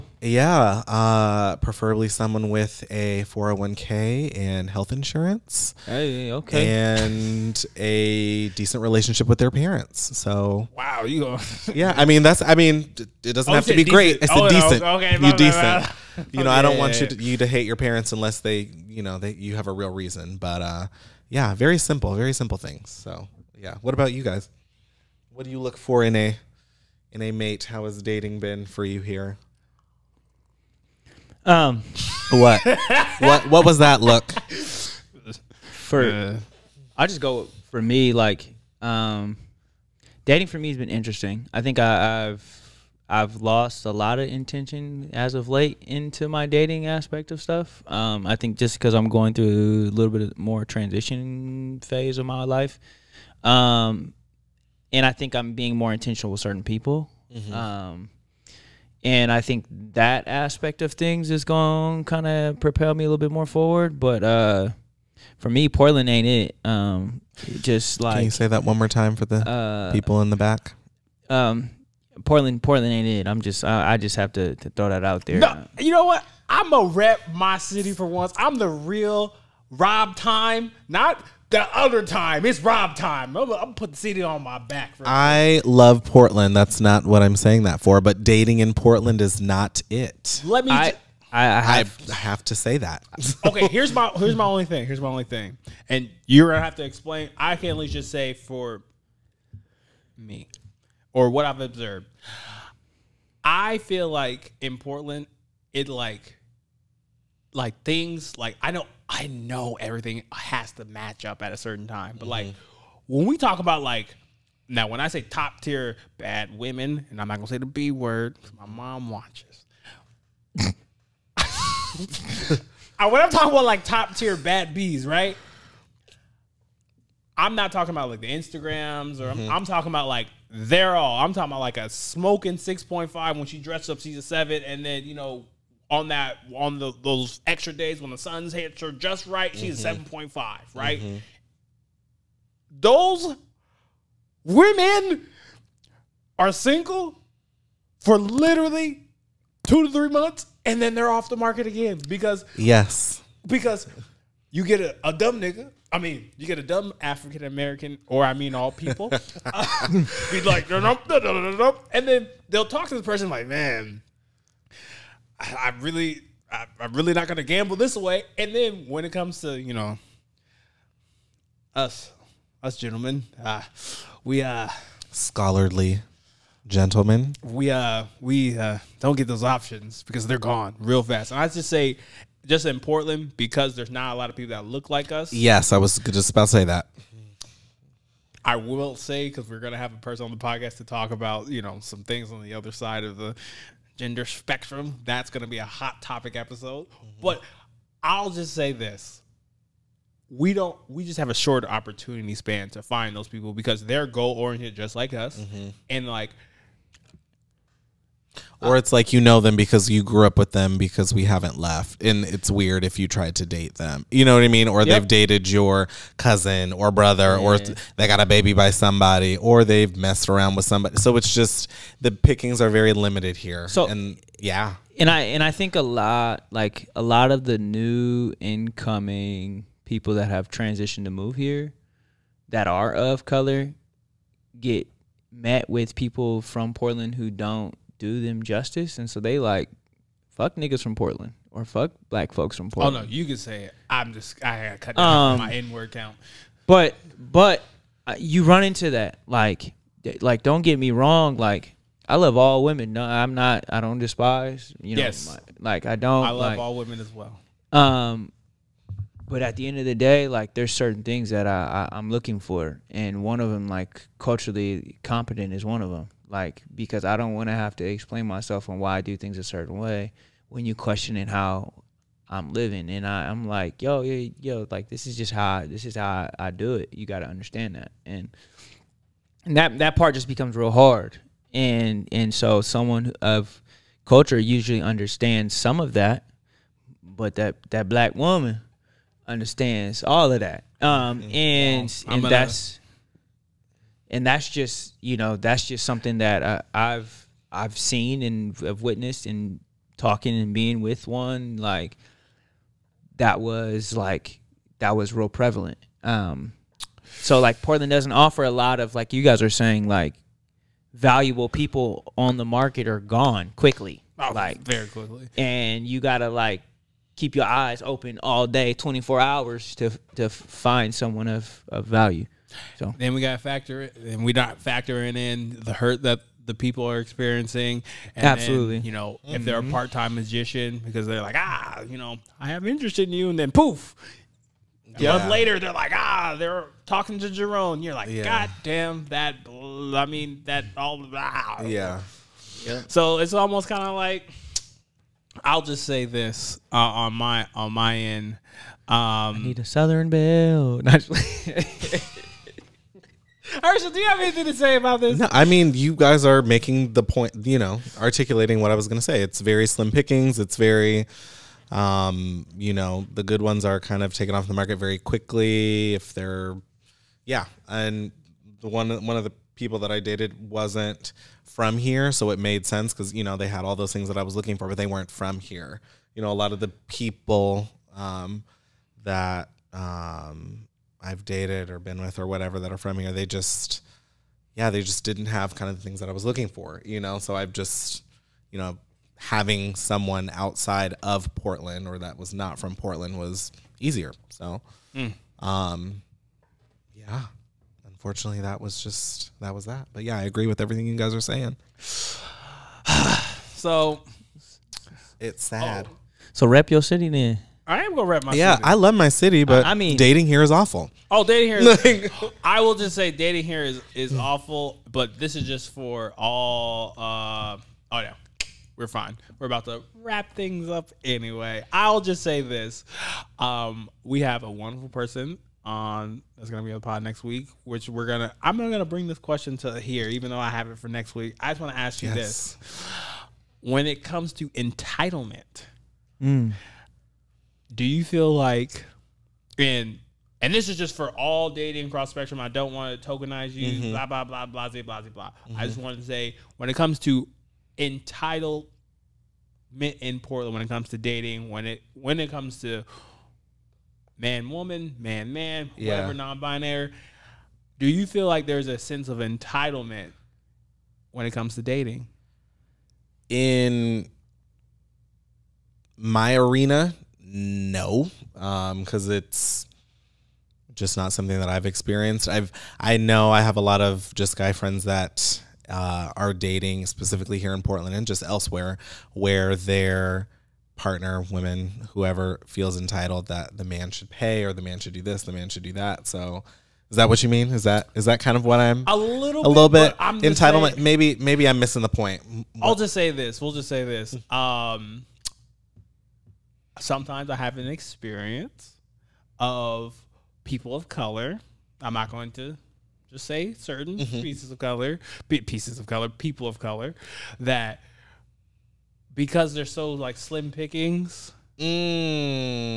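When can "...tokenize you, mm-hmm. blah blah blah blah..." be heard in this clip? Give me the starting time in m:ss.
7:23.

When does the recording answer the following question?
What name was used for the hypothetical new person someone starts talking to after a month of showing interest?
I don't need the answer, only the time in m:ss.
5:37.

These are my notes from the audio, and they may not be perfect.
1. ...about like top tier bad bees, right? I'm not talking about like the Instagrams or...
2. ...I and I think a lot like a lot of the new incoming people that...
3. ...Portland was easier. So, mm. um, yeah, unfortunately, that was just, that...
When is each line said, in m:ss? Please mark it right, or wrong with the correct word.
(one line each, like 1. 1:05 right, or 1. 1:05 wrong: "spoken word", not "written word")
1. 2:03 right
2. 3:45 right
3. 6:32 right.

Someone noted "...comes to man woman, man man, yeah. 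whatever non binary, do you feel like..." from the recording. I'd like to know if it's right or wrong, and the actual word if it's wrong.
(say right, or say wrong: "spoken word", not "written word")
right.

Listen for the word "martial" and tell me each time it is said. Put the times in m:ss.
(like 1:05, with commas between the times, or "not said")
not said.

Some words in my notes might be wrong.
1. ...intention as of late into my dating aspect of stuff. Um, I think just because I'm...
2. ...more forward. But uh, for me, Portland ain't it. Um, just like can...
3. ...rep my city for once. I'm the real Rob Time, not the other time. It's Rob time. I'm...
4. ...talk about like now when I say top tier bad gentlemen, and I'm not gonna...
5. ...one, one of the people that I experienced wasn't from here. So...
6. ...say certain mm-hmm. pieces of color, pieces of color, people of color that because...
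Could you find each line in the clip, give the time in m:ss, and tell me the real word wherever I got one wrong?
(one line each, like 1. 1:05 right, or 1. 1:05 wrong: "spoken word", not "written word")
1. 0:44 right
2. 1:03 right
3. 1:16 right
4. 1:53 wrong: "women", not "gentlemen"
5. 6:08 wrong: "dated", not "experienced"
6. 8:23 right.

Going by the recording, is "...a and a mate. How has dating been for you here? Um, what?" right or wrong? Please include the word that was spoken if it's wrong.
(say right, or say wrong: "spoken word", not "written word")
right.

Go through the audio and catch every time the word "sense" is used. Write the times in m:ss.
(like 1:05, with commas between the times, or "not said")
6:12, 7:38.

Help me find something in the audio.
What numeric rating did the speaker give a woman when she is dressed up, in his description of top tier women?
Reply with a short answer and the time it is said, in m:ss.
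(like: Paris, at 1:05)
7, at 2:13.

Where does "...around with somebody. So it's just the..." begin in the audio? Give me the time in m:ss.
3:40.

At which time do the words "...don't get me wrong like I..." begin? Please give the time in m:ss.
4:10.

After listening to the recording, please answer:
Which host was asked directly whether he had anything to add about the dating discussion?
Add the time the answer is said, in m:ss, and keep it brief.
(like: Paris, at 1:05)
Herschel, at 5:53.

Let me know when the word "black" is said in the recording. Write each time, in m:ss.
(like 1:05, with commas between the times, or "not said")
4:02, 4:47.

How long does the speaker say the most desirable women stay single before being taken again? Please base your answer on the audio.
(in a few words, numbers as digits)
2 to 3 months.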